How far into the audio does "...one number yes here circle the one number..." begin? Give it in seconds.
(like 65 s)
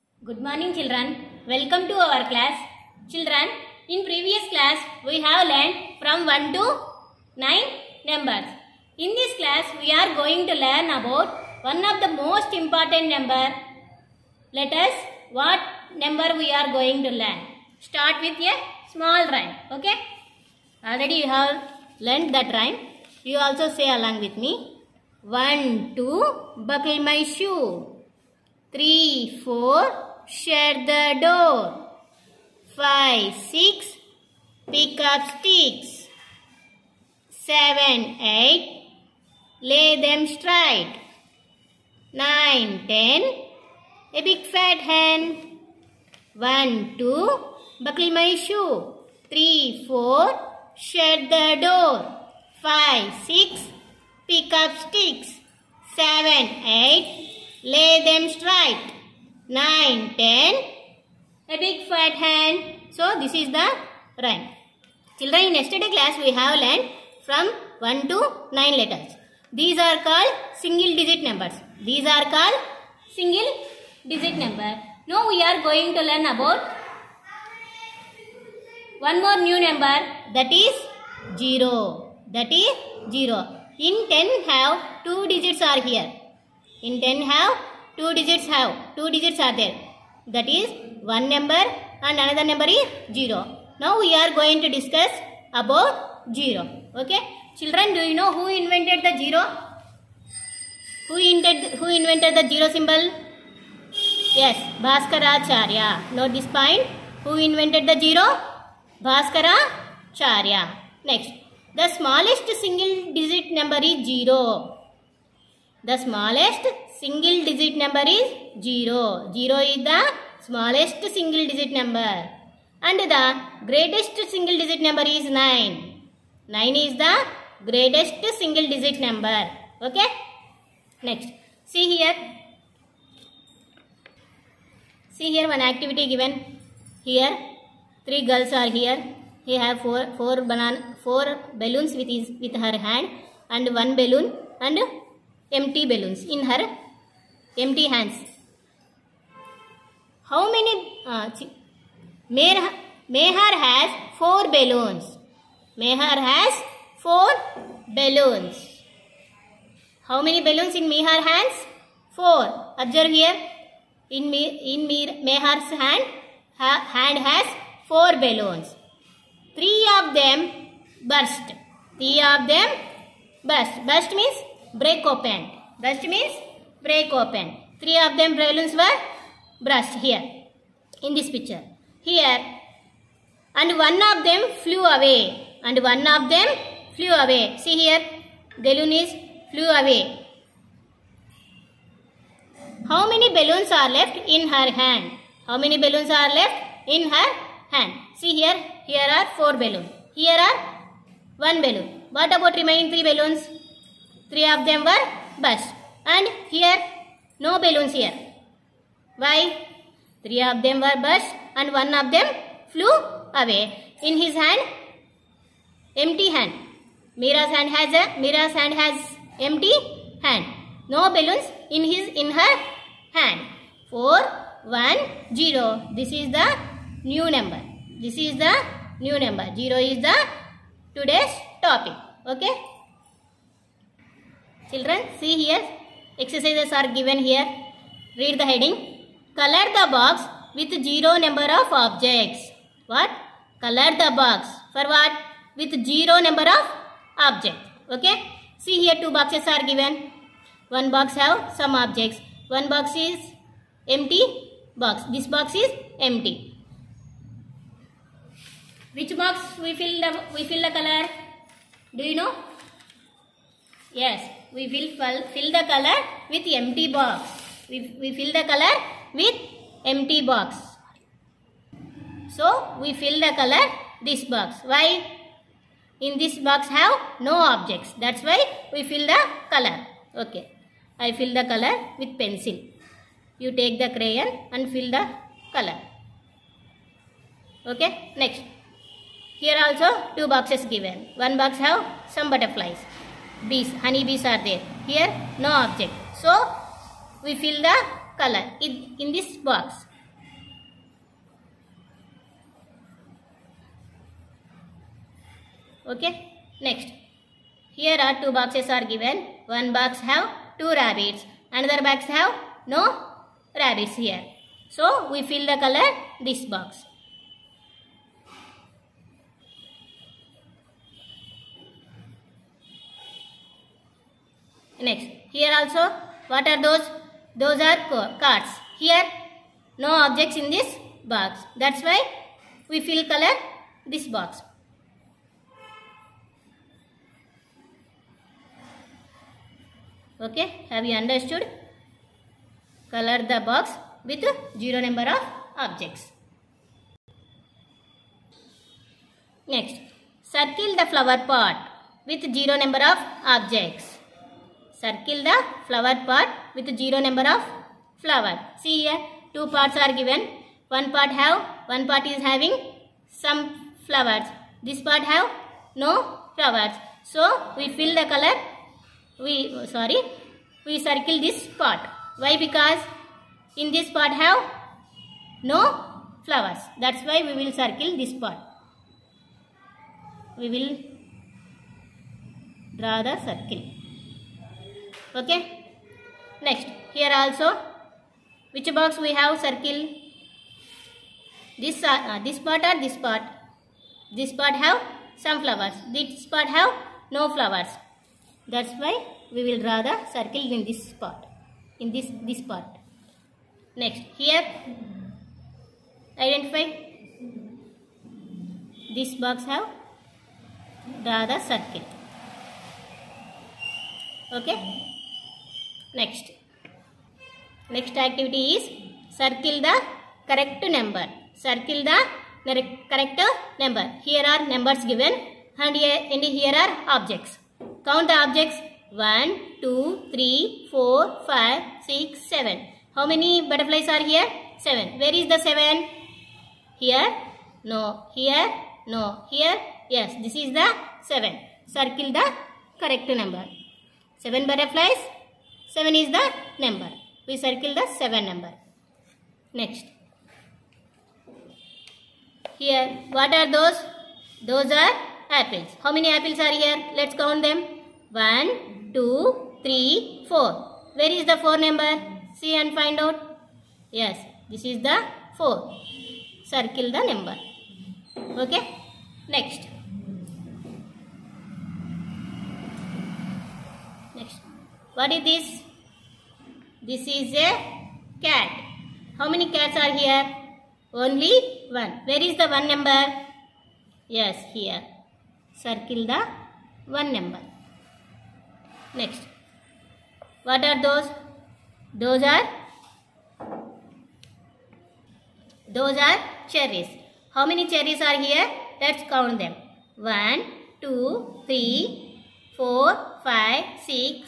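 482 s.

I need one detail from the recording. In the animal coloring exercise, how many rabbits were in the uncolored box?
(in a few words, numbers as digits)
2.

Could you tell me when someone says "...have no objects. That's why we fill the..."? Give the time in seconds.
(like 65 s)
276 s.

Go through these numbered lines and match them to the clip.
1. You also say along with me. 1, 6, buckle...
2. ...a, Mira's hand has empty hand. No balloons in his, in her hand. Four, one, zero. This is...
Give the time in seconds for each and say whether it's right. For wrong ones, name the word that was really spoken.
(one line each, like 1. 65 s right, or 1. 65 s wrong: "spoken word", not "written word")
1. 23 s wrong: "2", not "6"
2. 218 s right.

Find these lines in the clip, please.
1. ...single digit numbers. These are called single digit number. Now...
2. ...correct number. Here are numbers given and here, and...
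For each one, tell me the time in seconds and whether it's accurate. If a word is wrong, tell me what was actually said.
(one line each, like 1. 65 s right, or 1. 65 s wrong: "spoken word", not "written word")
1. 70 s right
2. 422 s right.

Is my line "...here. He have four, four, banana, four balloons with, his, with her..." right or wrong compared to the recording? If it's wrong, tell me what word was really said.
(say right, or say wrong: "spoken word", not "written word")
right.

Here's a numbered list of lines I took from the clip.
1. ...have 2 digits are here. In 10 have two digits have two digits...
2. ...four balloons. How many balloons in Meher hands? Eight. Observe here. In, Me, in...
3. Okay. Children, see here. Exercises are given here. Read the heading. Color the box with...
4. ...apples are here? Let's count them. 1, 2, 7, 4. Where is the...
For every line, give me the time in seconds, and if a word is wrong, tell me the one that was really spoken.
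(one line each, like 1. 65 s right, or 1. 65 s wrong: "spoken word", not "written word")
1. 84 s right
2. 156 s wrong: "Four", not "Eight"
3. 232 s right
4. 456 s wrong: "3", not "7".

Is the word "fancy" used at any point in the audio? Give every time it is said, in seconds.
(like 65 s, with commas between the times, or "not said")
not said.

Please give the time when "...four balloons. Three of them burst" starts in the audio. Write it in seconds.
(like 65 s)
167 s.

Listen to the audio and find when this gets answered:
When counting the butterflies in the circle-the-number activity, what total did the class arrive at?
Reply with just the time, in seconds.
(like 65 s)
444 s.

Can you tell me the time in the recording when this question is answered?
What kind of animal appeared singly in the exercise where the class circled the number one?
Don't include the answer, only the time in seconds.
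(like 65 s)
478 s.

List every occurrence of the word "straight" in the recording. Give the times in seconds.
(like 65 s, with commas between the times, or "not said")
40 s, 58 s.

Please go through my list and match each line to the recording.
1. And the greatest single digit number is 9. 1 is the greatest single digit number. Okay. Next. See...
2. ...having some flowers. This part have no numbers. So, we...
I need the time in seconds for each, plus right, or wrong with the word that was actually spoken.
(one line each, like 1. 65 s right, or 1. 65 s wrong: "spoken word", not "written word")
1. 122 s wrong: "9", not "1"
2. 362 s wrong: "flowers", not "numbers".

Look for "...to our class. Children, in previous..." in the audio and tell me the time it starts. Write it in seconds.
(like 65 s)
1 s.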